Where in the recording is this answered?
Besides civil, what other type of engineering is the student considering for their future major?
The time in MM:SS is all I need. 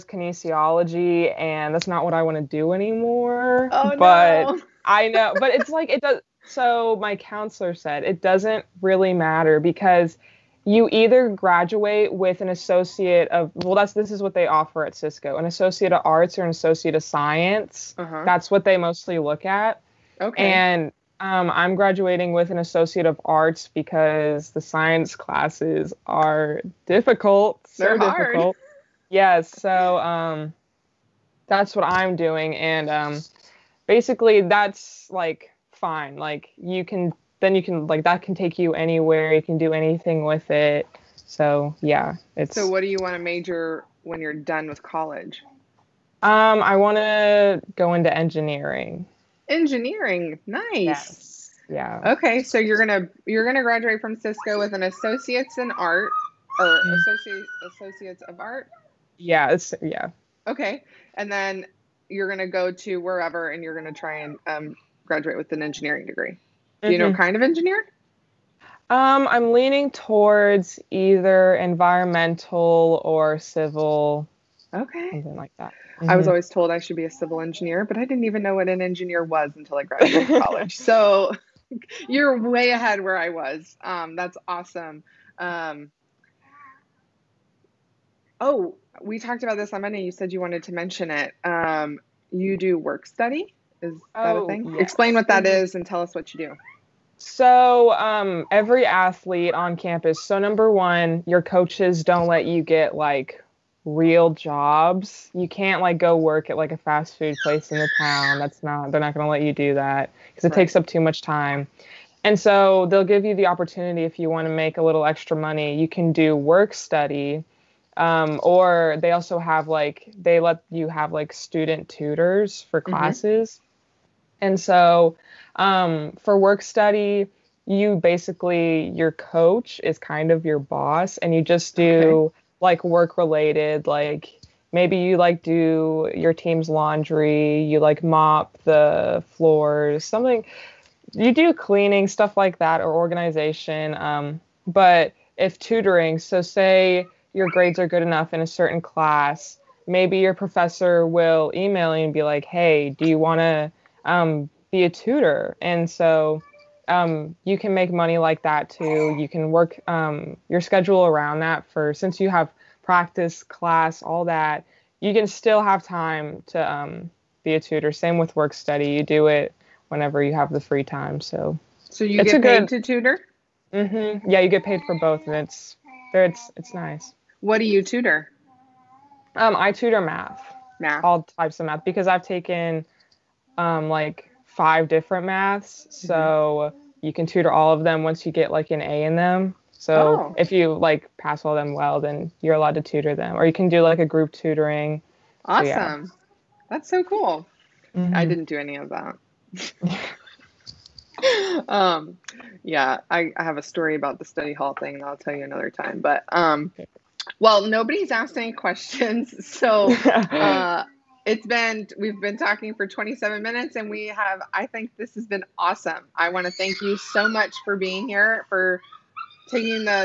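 01:11.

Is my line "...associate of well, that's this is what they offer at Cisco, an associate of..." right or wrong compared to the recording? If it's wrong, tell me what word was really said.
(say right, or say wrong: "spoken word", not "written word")
right.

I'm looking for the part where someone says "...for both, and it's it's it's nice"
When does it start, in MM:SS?
02:54.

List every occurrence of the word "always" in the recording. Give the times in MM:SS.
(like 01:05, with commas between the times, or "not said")
01:16.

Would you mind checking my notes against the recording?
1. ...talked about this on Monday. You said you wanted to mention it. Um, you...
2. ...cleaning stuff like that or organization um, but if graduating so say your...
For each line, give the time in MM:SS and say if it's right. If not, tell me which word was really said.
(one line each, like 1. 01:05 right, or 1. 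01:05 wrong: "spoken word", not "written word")
1. 01:29 right
2. 02:21 wrong: "tutoring", not "graduating".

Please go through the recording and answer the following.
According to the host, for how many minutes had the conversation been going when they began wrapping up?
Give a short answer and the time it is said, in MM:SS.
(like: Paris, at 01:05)
27, at 03:32.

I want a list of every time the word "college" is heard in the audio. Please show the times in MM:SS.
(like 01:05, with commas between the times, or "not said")
00:44, 01:20.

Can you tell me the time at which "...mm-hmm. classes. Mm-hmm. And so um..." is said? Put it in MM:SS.
02:02.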